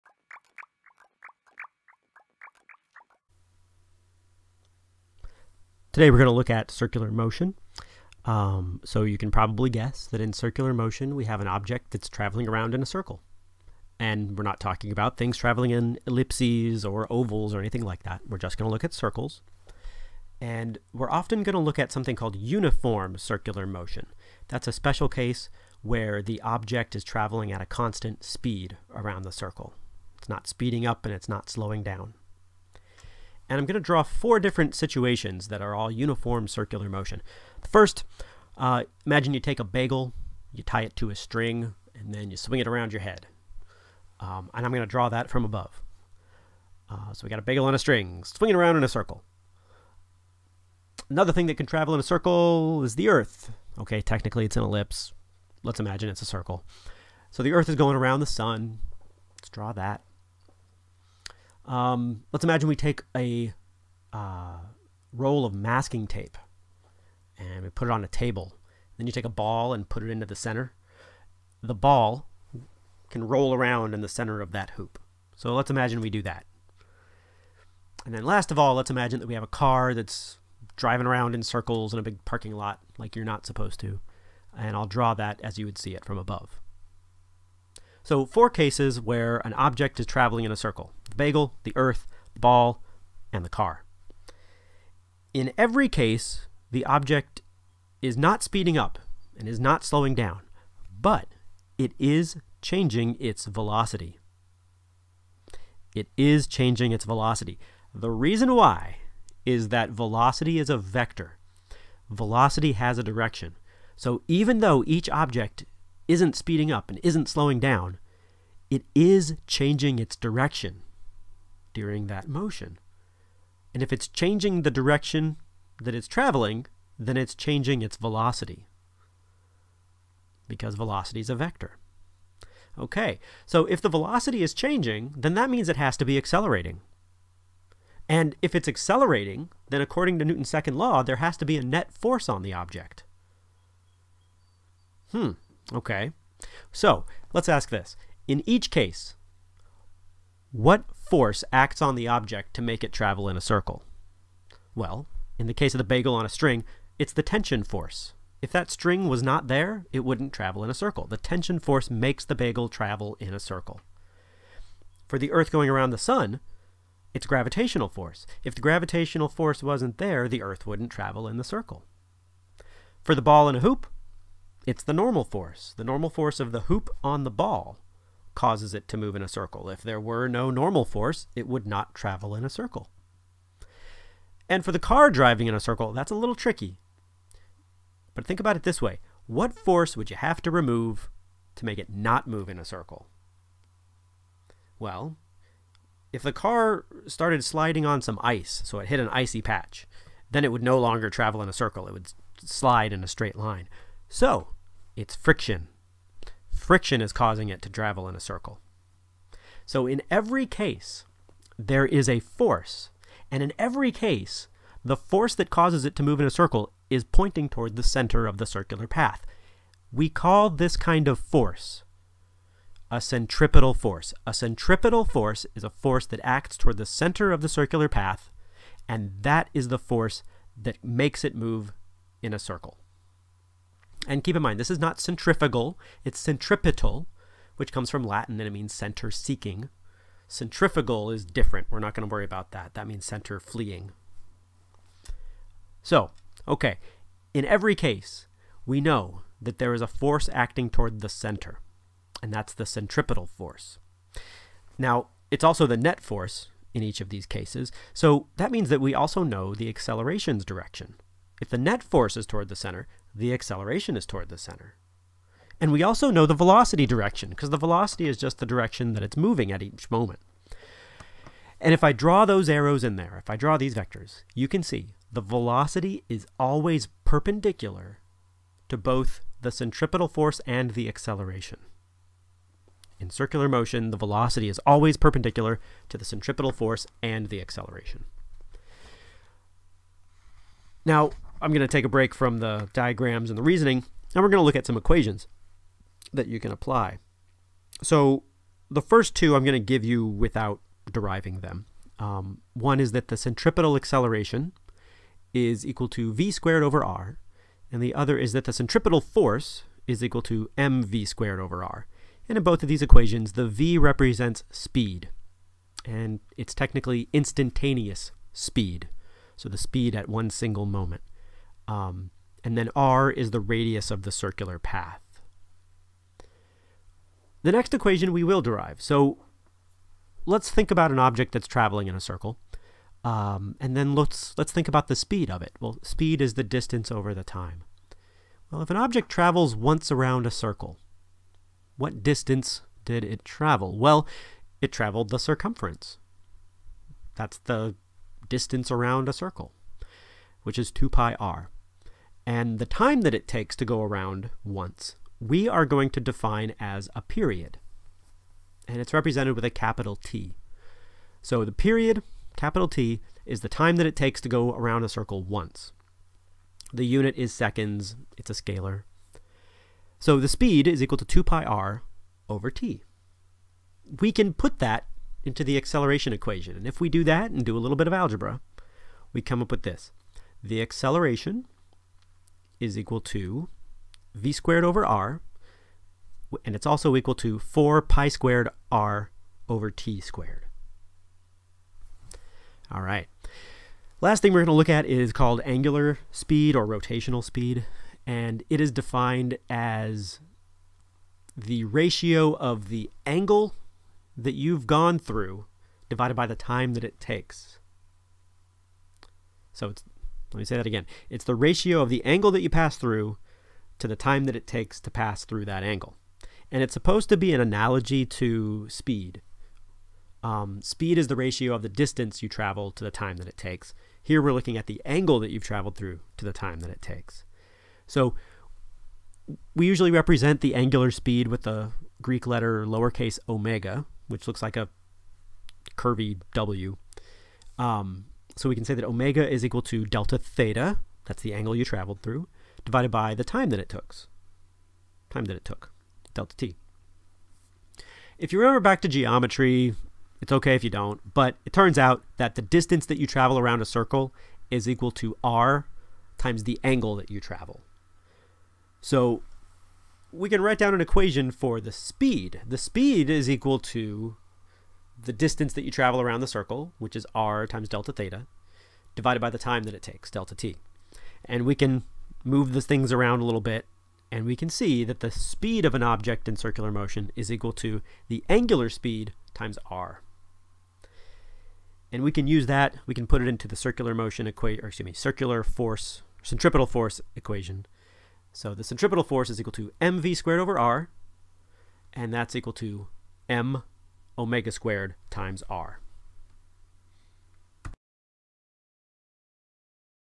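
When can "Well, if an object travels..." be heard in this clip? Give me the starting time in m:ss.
5:38.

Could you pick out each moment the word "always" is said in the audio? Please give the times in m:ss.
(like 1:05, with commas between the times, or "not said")
4:36, 4:44.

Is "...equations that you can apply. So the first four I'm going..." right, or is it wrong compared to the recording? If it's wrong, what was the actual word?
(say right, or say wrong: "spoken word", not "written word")
wrong: "two", not "four".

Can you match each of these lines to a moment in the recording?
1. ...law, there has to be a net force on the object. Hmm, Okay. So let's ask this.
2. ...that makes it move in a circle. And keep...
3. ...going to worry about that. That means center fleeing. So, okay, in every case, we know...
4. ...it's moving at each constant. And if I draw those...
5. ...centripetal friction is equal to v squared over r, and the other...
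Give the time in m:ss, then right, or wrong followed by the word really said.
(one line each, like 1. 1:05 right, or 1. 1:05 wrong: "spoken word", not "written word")
1. 2:20 right
2. 3:50 right
3. 4:01 right
4. 4:29 wrong: "moment", not "constant"
5. 5:03 wrong: "acceleration", not "friction".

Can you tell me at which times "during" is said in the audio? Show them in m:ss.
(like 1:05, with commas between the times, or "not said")
2:01.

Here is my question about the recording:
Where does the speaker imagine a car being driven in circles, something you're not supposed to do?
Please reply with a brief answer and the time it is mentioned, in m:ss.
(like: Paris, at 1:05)
a big parking lot, at 1:22.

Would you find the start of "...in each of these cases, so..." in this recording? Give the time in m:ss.
4:16.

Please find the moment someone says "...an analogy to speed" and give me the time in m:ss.
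6:57.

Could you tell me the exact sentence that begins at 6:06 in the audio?
The unit is seconds, it's a scalar.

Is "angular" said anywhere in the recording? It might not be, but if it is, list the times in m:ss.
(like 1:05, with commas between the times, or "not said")
6:35, 7:10, 7:58.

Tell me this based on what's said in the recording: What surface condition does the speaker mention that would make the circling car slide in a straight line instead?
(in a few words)
icy patch.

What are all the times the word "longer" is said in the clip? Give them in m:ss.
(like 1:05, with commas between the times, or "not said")
3:20.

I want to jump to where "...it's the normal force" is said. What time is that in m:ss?
2:54.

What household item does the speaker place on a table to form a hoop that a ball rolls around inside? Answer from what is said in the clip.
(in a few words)
masking tape.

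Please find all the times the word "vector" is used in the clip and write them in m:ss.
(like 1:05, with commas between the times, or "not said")
1:50, 2:11, 4:33.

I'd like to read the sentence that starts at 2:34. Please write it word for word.
Well, in the case of the bagel on a string, it's the tension force.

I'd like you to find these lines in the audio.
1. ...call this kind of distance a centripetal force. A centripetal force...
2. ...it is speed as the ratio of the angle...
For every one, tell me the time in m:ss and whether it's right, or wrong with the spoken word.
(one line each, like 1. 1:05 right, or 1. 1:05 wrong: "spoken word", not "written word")
1. 3:40 wrong: "force", not "distance"
2. 6:38 wrong: "defined", not "speed".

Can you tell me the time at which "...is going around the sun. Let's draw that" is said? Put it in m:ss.
0:57.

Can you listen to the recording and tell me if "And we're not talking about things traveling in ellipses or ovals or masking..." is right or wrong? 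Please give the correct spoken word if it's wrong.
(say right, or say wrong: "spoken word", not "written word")
wrong: "anything", not "masking".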